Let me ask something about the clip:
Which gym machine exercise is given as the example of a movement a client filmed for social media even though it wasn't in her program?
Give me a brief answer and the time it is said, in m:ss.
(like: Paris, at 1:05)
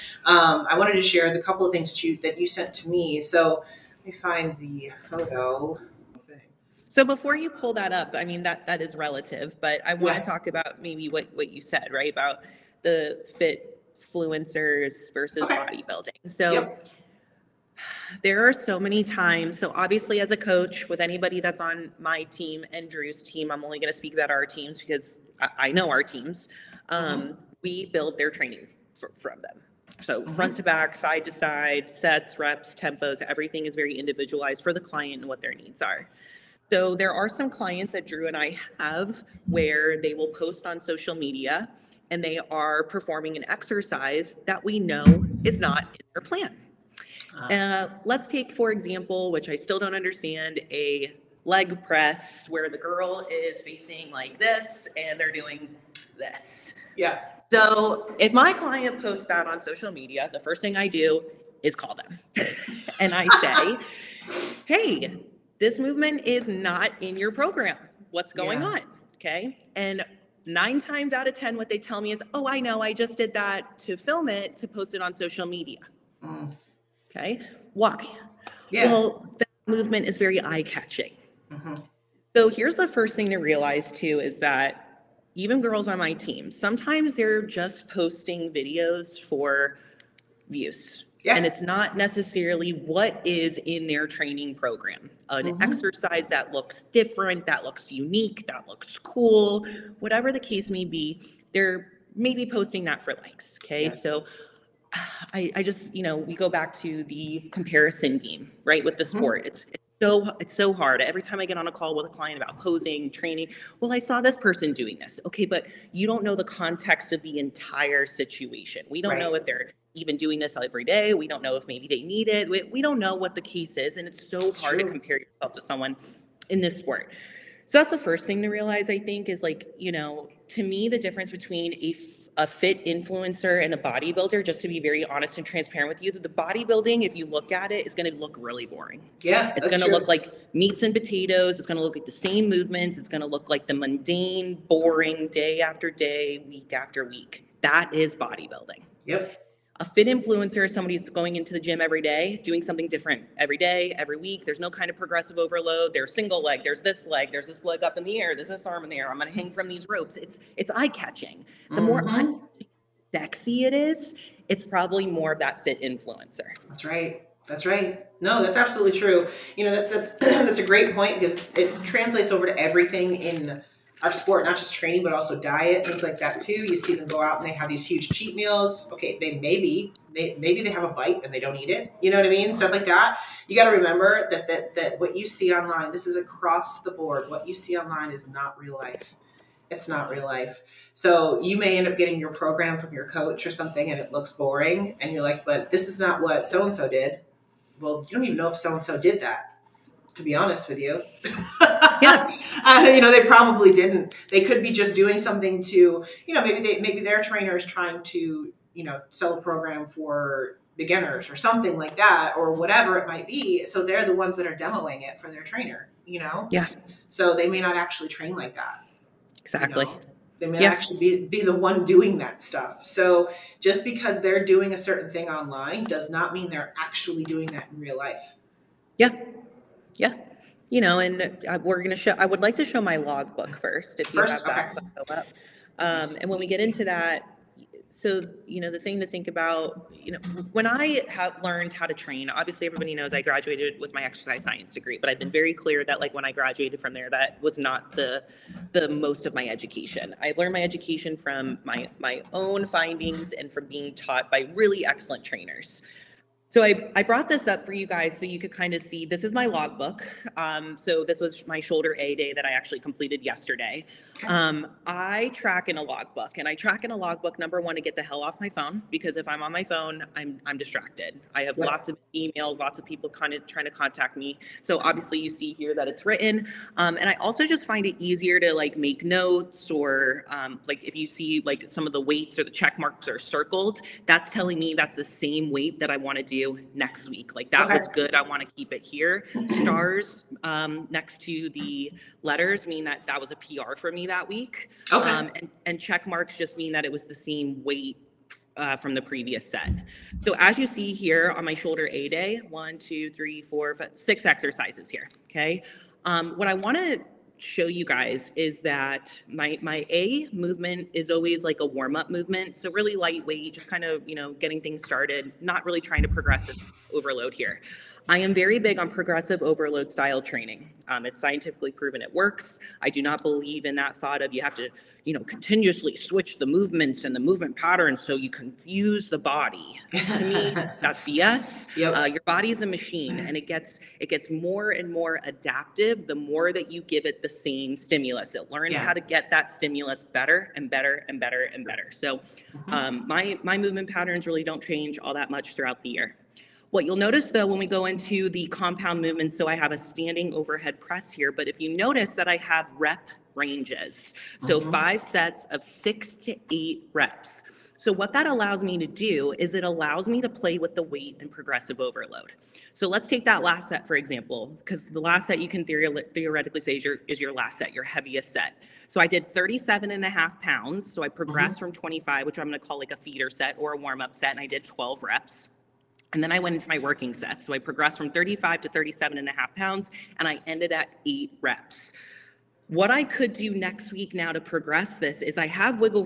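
Leg press, at 0:51.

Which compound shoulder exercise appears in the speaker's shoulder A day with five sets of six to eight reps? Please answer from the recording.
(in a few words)
Standing overhead press.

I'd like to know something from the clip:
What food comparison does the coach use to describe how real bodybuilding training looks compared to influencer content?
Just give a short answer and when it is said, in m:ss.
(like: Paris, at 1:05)
Meats and potatoes, at 2:20.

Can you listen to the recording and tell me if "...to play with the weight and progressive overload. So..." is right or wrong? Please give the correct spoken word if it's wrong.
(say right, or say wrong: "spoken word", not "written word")
right.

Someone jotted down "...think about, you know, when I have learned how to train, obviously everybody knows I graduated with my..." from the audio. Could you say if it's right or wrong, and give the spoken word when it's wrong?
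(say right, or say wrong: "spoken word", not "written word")
right.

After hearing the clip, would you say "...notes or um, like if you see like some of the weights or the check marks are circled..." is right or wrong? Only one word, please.
right.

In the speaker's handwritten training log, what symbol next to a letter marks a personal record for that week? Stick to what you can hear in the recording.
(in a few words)
Stars.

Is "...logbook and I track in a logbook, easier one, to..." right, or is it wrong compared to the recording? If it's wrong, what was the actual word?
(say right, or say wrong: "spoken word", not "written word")
wrong: "number", not "easier".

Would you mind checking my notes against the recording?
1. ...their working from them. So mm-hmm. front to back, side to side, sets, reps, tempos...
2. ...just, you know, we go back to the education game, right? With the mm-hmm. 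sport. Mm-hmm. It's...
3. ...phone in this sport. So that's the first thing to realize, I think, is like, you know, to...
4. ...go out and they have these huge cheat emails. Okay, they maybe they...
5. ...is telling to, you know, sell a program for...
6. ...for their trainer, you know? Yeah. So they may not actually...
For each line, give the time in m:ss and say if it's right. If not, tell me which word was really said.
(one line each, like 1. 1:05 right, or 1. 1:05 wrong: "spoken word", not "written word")
1. 0:28 wrong: "training", not "working"
2. 1:45 wrong: "comparison", not "education"
3. 2:05 wrong: "someone", not "phone"
4. 2:57 wrong: "meals", not "emails"
5. 3:27 wrong: "trying", not "telling"
6. 3:35 right.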